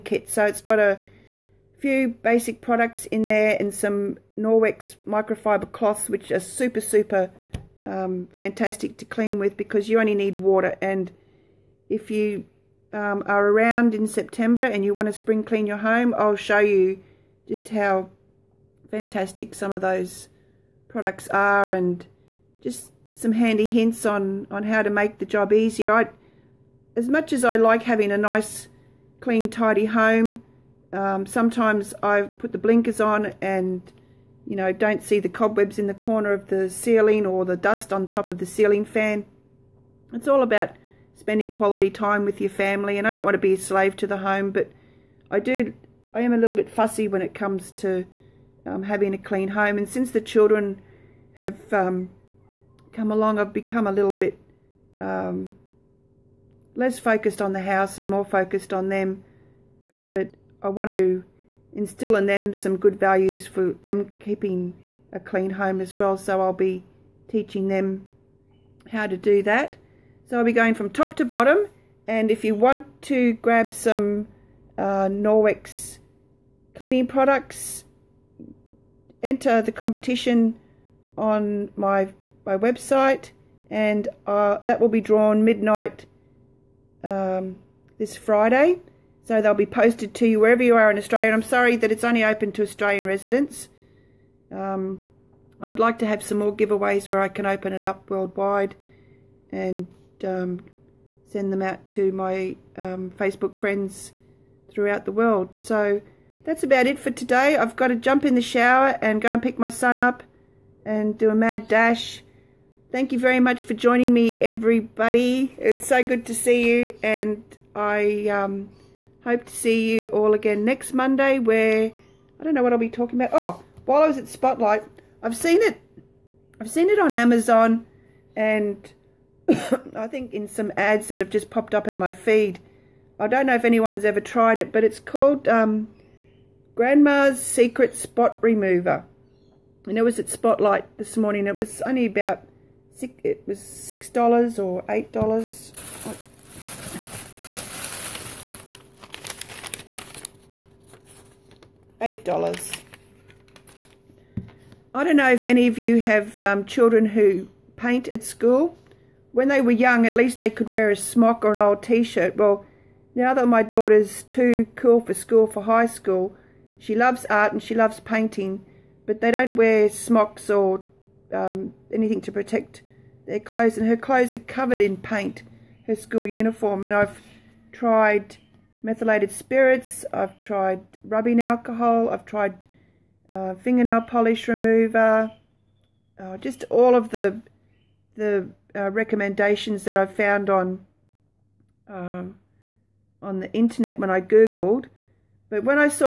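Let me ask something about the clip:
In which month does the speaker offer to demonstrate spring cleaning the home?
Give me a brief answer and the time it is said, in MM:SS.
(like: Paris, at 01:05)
September, at 00:14.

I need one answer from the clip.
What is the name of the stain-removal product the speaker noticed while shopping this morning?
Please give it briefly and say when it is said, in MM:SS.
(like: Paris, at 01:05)
Grandma's Secret Spot Remover, at 02:16.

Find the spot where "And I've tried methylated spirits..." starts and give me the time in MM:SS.
02:56.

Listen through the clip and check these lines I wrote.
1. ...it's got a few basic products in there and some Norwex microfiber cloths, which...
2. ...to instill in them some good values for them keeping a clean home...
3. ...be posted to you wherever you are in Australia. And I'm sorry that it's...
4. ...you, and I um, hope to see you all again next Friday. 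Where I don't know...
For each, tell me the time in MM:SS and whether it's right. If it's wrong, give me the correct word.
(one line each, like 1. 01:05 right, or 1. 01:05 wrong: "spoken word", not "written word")
1. 00:00 right
2. 01:00 right
3. 01:29 right
4. 01:56 wrong: "Monday", not "Friday".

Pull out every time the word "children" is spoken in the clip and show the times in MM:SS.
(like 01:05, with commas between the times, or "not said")
00:50, 02:36.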